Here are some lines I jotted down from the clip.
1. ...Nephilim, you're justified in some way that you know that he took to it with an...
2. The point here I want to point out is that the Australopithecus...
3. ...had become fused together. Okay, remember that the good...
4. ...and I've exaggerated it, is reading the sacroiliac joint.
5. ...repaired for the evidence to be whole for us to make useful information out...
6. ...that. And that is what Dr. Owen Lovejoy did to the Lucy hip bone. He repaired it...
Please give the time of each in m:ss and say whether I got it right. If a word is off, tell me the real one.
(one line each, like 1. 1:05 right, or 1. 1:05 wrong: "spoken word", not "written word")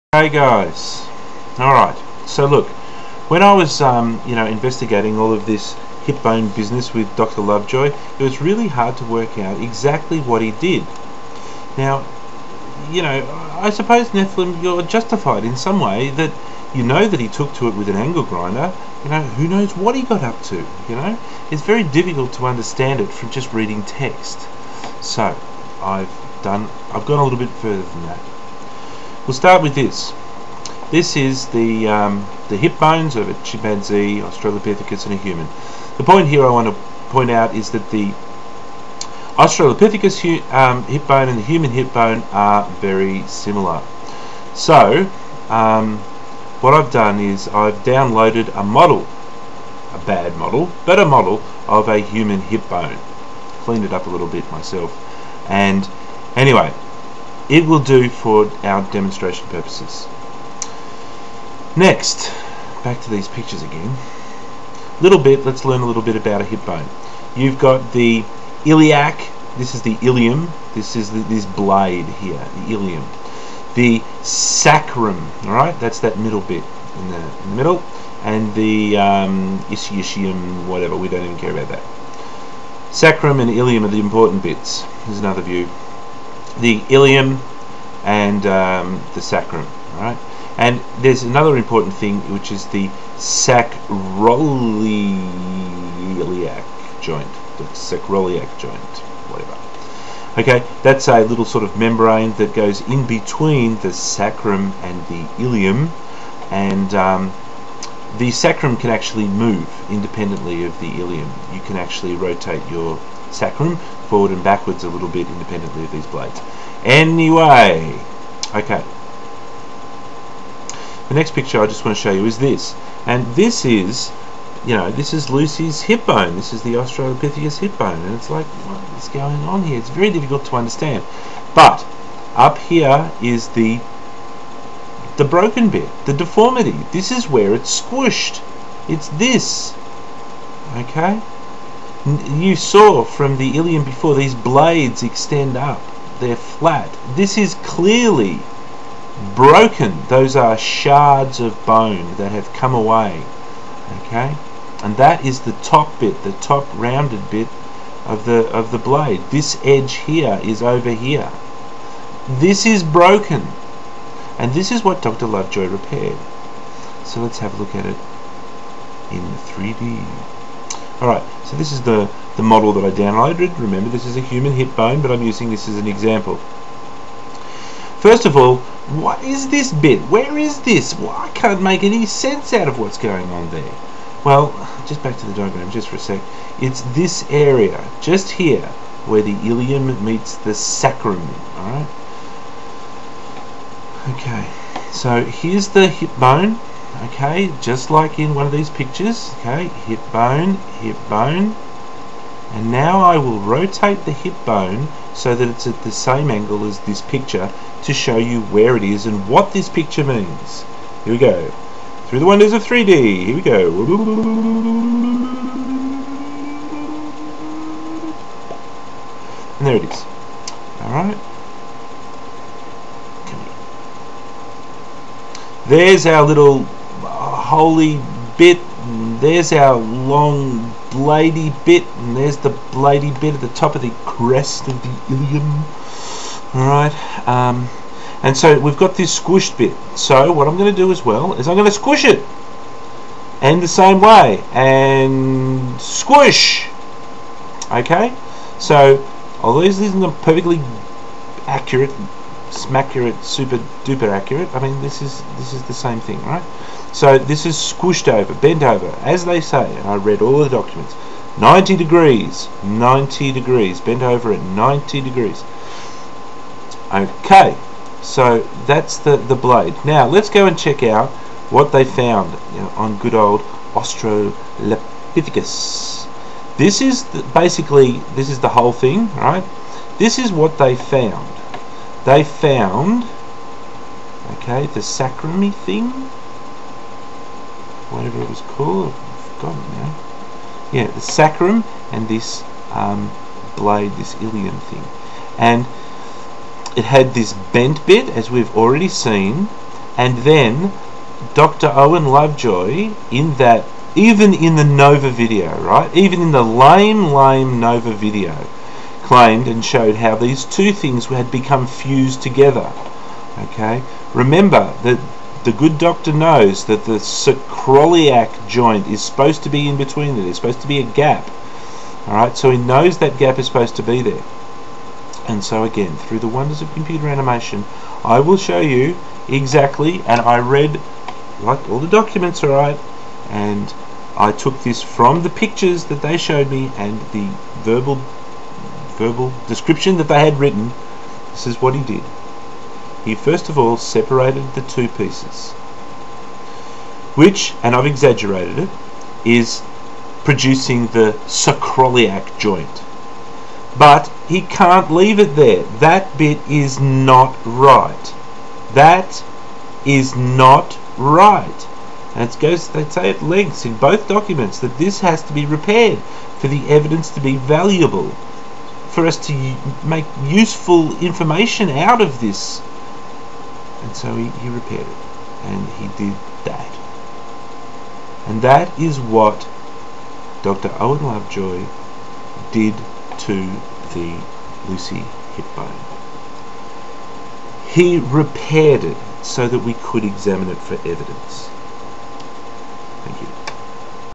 1. 0:14 right
2. 0:35 right
3. 5:11 right
4. 5:47 wrong: "producing", not "reading"
5. 6:05 wrong: "valuable", not "whole"
6. 6:16 right.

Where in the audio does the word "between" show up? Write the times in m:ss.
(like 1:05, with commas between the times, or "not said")
1:43, 5:19.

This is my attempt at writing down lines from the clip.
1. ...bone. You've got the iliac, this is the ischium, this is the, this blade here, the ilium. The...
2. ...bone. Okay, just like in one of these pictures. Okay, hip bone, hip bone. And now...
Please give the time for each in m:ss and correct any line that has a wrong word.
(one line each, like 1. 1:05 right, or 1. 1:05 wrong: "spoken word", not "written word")
1. 1:06 wrong: "ilium", not "ischium"
2. 3:16 right.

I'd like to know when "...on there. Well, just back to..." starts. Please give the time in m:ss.
3:03.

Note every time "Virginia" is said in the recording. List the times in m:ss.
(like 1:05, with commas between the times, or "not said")
not said.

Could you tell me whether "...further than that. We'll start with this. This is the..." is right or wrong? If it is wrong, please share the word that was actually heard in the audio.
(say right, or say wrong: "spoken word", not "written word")
right.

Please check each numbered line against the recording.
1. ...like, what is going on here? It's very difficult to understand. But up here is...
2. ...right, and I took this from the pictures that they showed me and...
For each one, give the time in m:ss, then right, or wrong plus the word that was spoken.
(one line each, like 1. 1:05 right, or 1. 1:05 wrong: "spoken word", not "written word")
1. 2:08 right
2. 5:32 right.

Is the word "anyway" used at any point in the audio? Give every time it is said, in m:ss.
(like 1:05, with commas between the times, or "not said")
0:56, 1:56.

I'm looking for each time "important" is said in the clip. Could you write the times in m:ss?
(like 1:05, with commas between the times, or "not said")
1:23, 1:31.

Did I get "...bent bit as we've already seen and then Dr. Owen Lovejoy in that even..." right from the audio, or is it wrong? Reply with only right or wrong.
right.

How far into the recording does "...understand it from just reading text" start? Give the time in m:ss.
0:22.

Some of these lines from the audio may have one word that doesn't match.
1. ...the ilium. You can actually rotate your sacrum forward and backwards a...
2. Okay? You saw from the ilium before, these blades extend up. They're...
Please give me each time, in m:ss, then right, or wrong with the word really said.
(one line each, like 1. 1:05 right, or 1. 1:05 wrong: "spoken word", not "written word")
1. 1:50 right
2. 2:20 right.